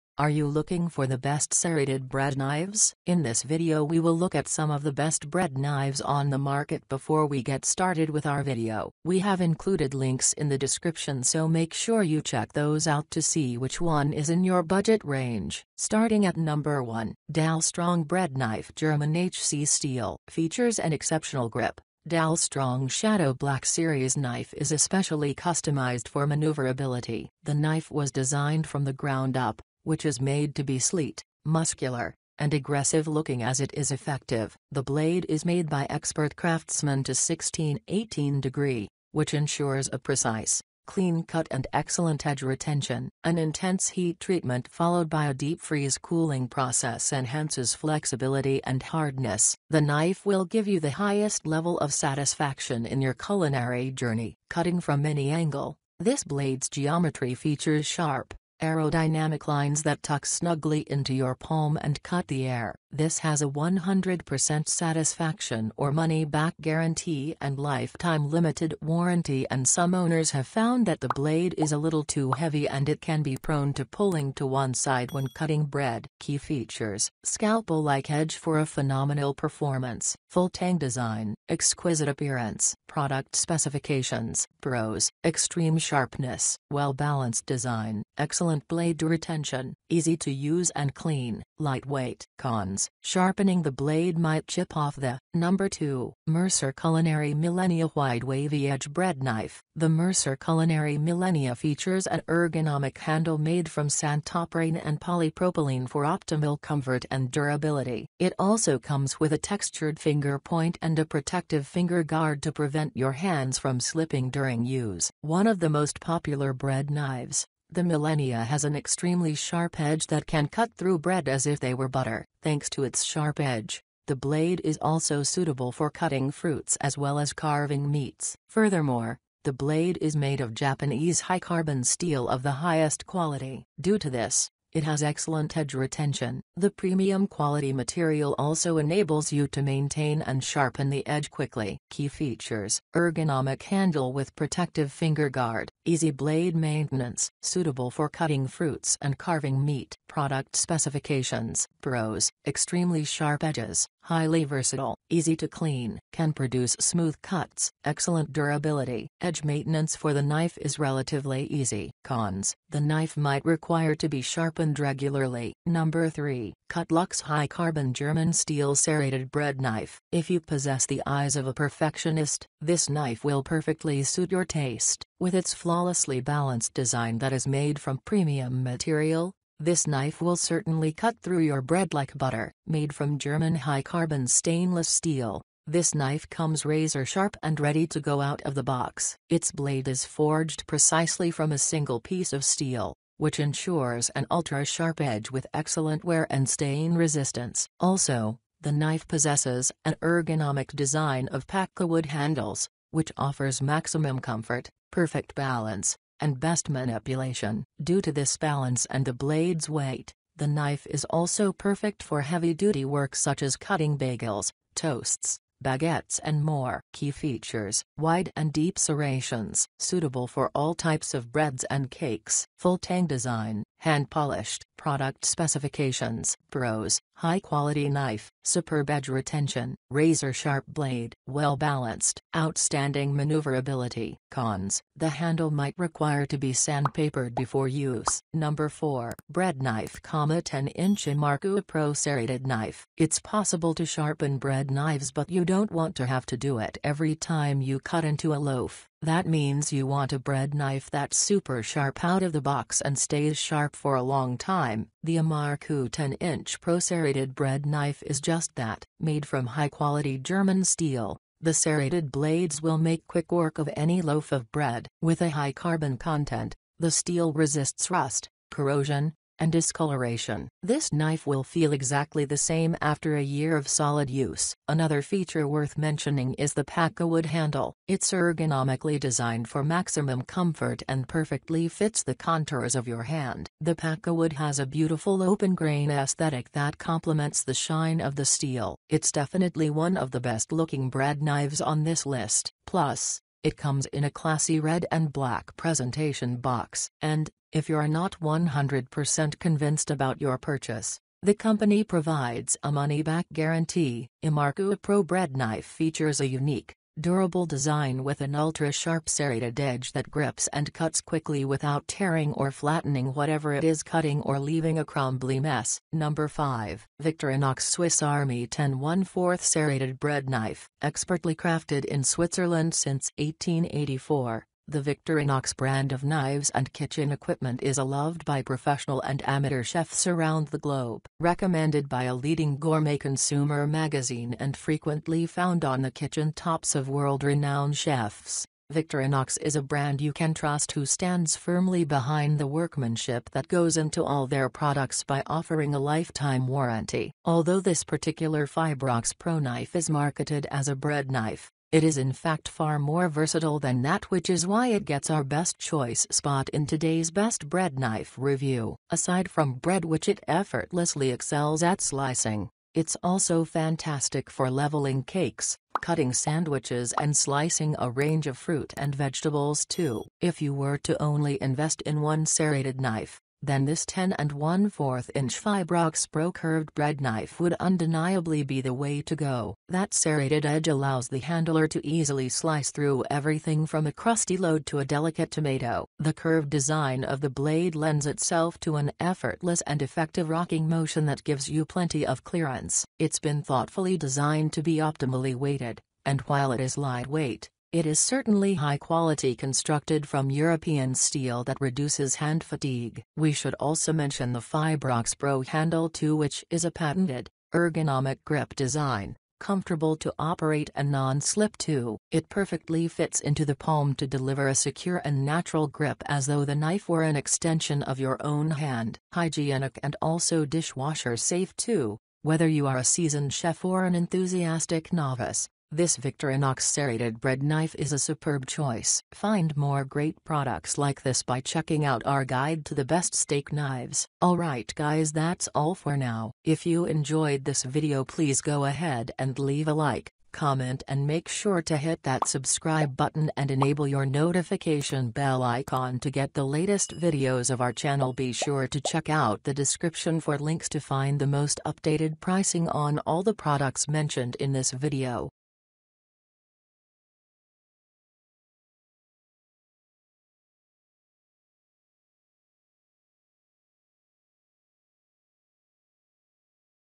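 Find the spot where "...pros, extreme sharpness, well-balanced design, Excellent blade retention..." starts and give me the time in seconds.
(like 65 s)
84 s.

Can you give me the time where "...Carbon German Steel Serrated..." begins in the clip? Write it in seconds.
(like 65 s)
167 s.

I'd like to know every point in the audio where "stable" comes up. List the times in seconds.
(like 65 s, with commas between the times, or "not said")
not said.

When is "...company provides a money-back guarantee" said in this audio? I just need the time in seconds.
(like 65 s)
301 s.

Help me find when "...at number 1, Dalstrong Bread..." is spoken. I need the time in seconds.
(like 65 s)
16 s.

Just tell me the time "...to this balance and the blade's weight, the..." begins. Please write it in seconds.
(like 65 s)
208 s.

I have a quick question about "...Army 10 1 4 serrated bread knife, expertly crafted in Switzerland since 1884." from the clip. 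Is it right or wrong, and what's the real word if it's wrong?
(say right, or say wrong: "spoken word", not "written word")
right.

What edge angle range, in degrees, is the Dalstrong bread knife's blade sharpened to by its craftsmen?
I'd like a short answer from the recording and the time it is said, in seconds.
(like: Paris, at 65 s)
16-18 degrees, at 37 s.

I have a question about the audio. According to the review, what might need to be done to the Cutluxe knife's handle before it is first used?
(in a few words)
Sandpapered.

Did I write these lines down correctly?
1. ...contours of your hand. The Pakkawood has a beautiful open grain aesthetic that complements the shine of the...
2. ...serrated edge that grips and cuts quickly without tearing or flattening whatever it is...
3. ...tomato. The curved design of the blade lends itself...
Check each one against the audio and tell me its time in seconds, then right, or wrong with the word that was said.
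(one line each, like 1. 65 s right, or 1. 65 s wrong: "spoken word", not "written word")
1. 282 s right
2. 309 s right
3. 385 s right.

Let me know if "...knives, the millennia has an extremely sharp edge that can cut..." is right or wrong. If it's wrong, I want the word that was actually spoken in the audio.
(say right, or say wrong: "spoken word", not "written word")
right.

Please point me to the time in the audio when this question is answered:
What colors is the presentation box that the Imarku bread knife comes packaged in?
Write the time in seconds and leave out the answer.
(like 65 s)
294 s.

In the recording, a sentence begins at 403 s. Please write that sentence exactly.
We should also mention the Fibrox Pro handle 2 which is a patented, ergonomic grip design, comfortable to operate and non-slip too.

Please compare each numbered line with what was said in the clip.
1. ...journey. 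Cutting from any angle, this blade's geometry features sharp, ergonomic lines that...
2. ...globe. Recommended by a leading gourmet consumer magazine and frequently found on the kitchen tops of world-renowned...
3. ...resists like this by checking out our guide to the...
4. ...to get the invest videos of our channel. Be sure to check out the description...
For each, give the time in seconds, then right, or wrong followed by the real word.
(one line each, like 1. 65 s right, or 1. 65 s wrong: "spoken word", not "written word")
1. 53 s wrong: "aerodynamic", not "ergonomic"
2. 330 s right
3. 430 s wrong: "products", not "resists"
4. 445 s wrong: "latest", not "invest".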